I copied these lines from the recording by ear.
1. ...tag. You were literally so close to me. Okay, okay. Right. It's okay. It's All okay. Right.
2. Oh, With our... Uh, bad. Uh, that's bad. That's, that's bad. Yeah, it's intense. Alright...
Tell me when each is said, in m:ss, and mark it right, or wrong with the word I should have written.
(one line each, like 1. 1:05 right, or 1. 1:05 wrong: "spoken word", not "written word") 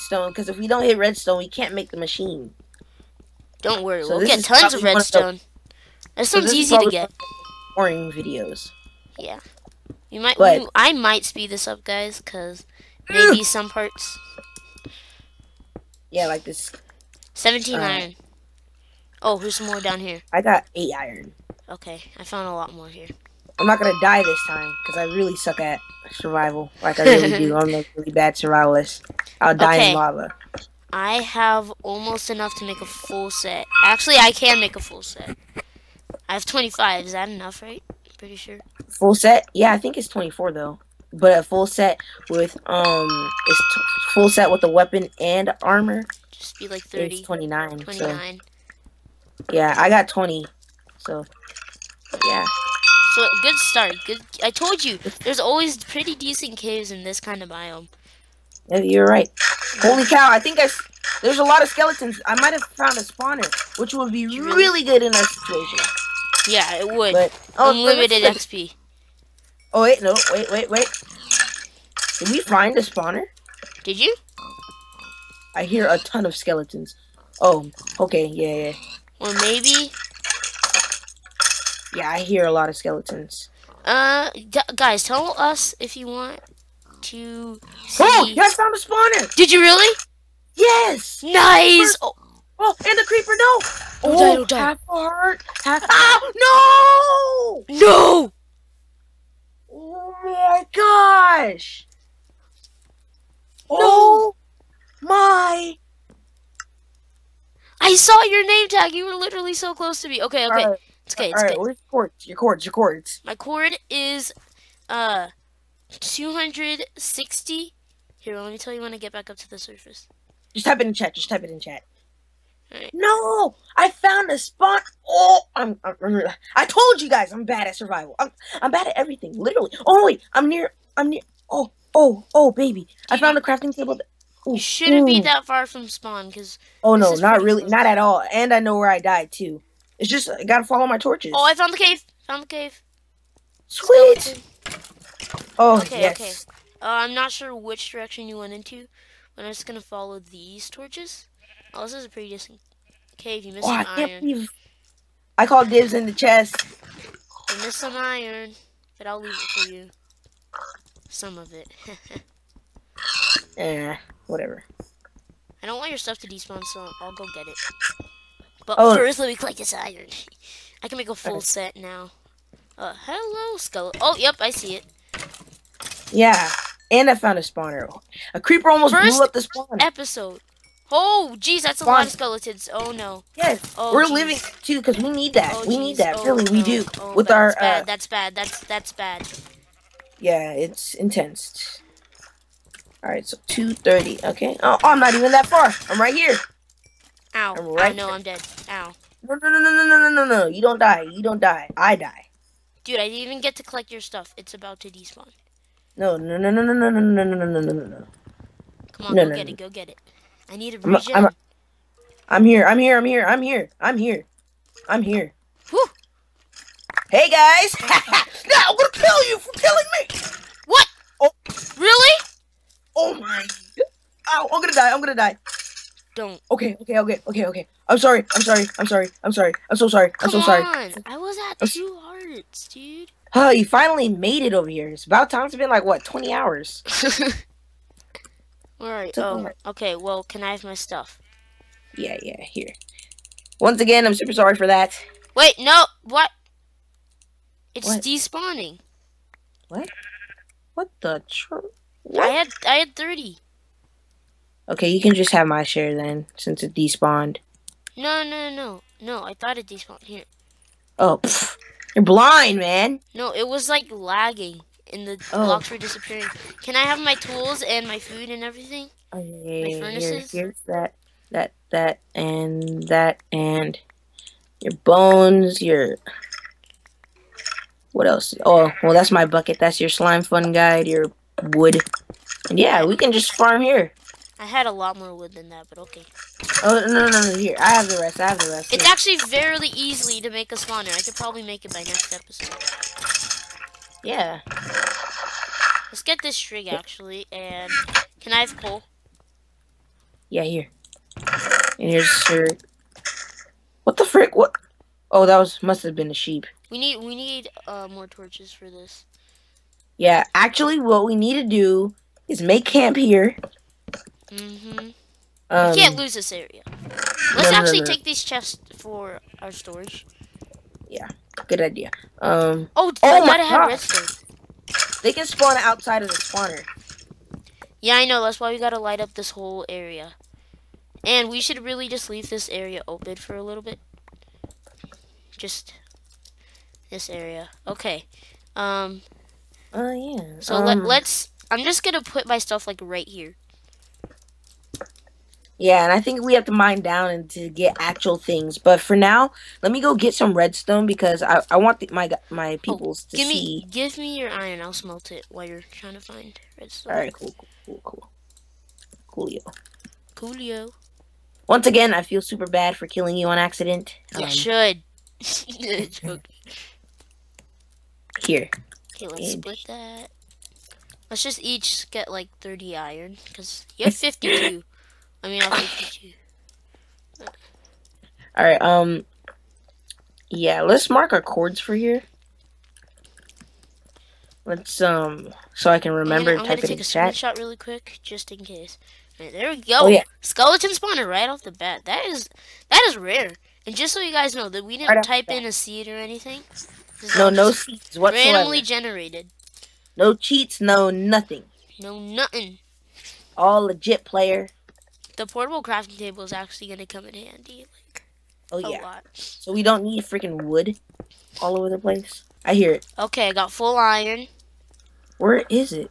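1. 1:48 right
2. 3:06 right.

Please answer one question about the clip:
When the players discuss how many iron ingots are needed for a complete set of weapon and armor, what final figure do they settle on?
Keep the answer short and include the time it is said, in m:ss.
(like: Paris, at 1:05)
29, at 0:47.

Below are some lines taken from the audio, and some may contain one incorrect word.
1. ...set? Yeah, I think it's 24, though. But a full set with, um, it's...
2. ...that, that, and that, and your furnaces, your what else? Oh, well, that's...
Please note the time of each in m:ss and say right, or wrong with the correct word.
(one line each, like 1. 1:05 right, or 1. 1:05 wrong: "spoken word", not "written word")
1. 0:39 right
2. 4:31 wrong: "bones", not "furnaces".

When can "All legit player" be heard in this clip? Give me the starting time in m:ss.
6:43.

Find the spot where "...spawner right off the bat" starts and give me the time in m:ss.
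6:30.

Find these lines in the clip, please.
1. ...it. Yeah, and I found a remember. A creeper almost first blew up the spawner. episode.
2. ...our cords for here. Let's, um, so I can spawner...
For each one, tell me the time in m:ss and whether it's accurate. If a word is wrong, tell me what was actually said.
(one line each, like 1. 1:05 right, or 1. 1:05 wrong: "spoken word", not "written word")
1. 2:54 wrong: "spawner", not "remember"
2. 6:21 wrong: "remember", not "spawner".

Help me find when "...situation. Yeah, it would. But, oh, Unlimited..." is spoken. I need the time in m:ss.
1:05.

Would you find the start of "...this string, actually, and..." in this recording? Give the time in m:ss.
4:56.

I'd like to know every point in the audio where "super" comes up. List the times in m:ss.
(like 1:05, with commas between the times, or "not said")
4:04, 6:02.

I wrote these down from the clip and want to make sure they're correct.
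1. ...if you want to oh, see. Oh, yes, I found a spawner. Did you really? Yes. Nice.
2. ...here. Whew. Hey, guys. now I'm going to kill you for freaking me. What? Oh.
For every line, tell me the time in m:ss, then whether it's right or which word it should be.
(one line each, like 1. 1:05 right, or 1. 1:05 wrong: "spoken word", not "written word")
1. 1:25 right
2. 3:35 wrong: "killing", not "freaking".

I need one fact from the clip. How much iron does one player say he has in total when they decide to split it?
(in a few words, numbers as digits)
52.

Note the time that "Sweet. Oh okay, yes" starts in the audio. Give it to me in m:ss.
2:23.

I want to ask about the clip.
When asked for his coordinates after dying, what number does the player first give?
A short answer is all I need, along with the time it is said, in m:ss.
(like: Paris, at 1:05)
260, at 1:55.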